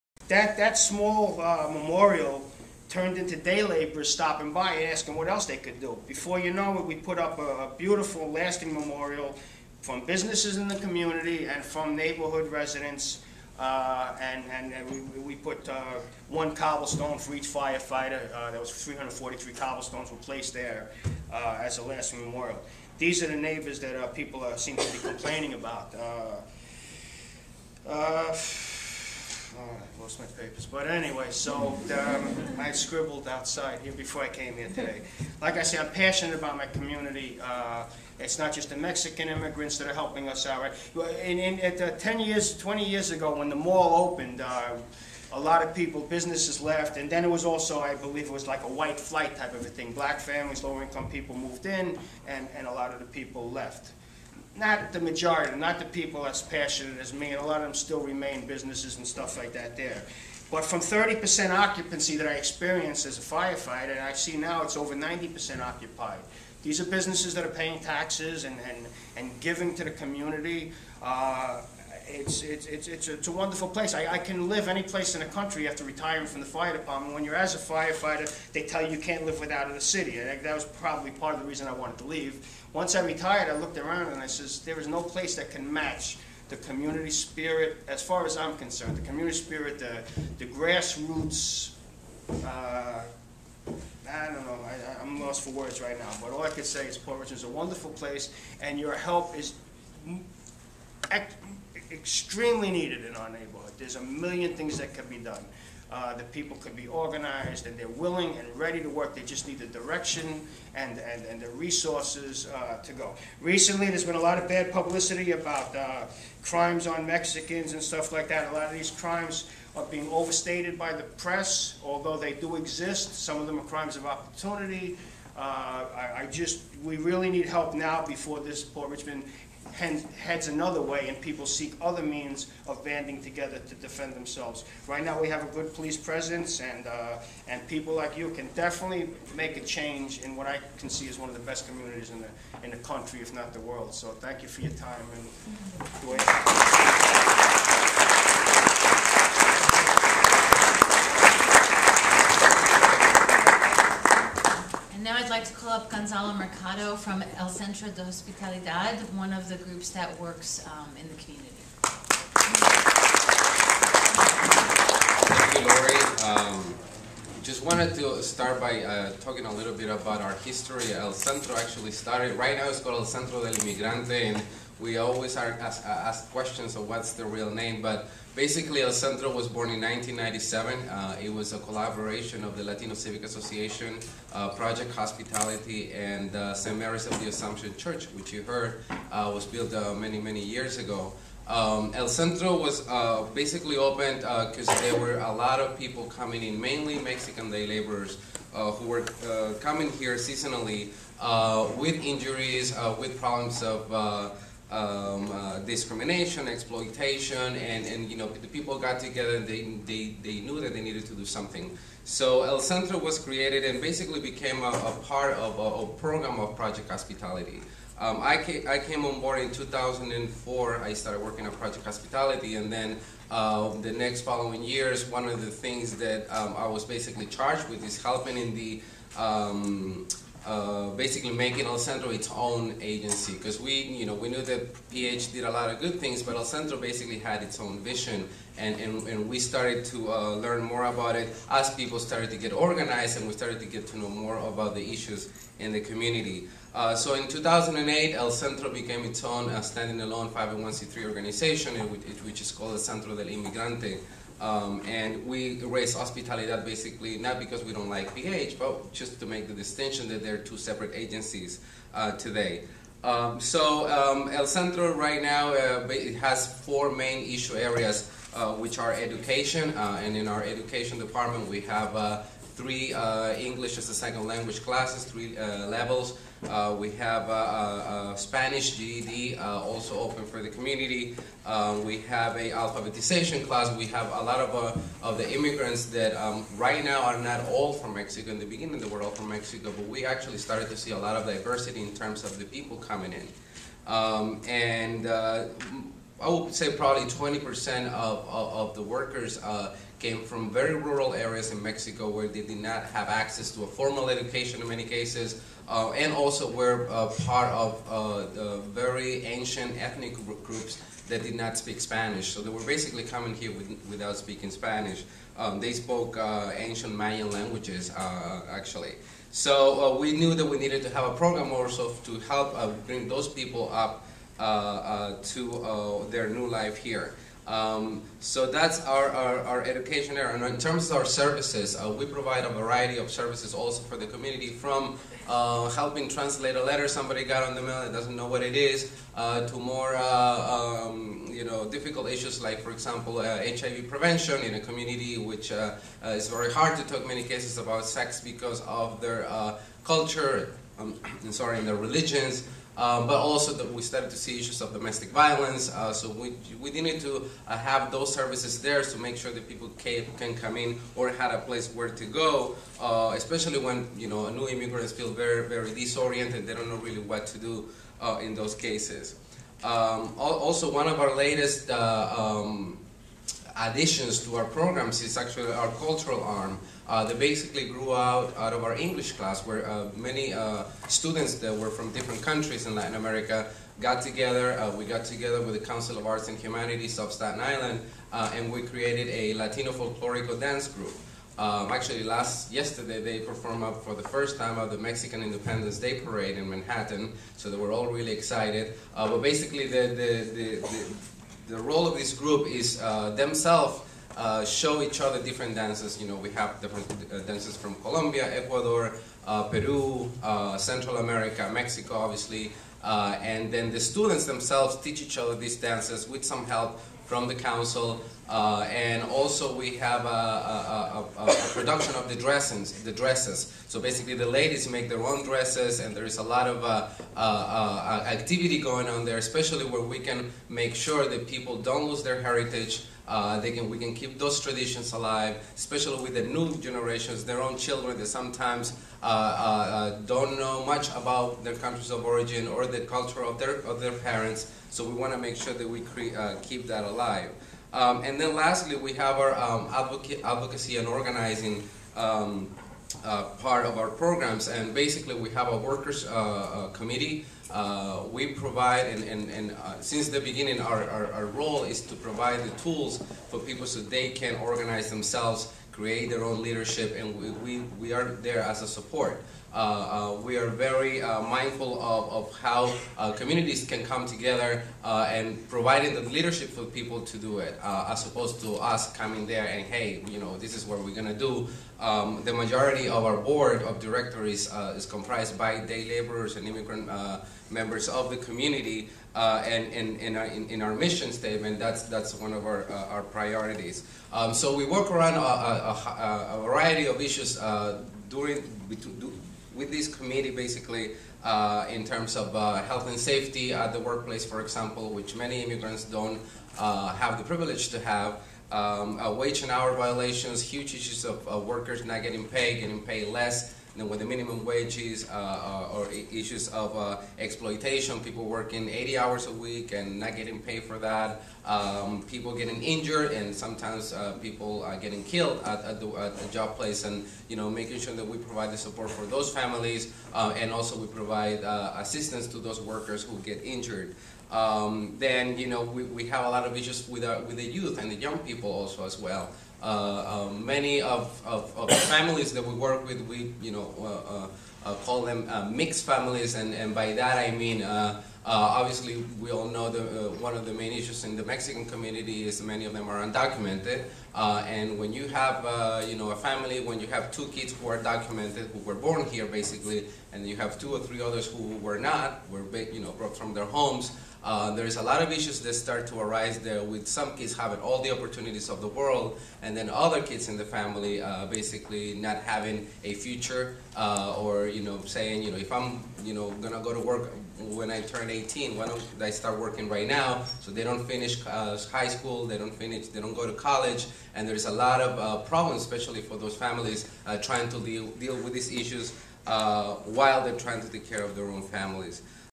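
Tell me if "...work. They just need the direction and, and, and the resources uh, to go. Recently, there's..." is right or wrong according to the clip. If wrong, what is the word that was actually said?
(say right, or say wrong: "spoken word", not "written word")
right.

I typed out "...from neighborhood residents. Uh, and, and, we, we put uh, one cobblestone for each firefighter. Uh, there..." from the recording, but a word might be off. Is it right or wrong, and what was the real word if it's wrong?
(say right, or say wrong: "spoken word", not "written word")
right.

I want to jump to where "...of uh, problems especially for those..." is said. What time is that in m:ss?
9:44.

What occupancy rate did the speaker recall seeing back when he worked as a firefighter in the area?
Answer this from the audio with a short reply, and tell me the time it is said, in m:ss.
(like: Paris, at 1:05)
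30%, at 1:00.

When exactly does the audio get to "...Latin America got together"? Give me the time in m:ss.
6:22.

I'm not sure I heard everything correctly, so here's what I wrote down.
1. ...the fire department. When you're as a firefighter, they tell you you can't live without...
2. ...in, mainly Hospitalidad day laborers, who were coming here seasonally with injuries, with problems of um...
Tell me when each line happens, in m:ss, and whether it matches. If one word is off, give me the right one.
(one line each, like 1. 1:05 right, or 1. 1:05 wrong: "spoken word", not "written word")
1. 1:16 right
2. 3:16 wrong: "Mexican", not "Hospitalidad".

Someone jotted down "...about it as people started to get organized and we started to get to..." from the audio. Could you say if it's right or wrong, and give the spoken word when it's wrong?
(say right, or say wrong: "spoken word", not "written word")
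right.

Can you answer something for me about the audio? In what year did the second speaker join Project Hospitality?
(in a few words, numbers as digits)
2004.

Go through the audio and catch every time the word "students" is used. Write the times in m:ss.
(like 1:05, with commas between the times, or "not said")
6:20, 6:53.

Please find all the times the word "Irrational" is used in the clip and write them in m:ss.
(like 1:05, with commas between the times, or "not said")
not said.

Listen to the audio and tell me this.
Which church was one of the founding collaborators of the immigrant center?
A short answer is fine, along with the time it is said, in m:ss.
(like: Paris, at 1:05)
St. Mary's of the Assumption, at 3:06.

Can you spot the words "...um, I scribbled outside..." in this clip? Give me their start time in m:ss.
0:31.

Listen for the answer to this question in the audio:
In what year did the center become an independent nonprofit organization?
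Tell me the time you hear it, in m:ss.
4:07.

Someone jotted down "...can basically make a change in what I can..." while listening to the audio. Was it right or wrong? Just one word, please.
wrong.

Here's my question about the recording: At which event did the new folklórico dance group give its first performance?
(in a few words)
Mexican Independence Day Parade.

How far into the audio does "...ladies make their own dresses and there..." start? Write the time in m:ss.
7:04.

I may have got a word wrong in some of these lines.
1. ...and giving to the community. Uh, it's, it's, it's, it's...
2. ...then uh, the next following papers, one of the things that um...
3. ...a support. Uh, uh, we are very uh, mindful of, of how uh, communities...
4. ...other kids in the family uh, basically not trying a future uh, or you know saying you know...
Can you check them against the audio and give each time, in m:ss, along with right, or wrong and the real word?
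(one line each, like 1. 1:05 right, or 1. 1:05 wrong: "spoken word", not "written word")
1. 1:09 right
2. 3:42 wrong: "years", not "papers"
3. 7:48 right
4. 9:29 wrong: "having", not "trying".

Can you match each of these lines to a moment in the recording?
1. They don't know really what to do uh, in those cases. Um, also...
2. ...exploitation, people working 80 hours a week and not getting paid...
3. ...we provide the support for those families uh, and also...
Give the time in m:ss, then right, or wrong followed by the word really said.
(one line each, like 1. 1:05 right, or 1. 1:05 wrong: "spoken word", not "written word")
1. 6:06 right
2. 8:37 right
3. 8:48 right.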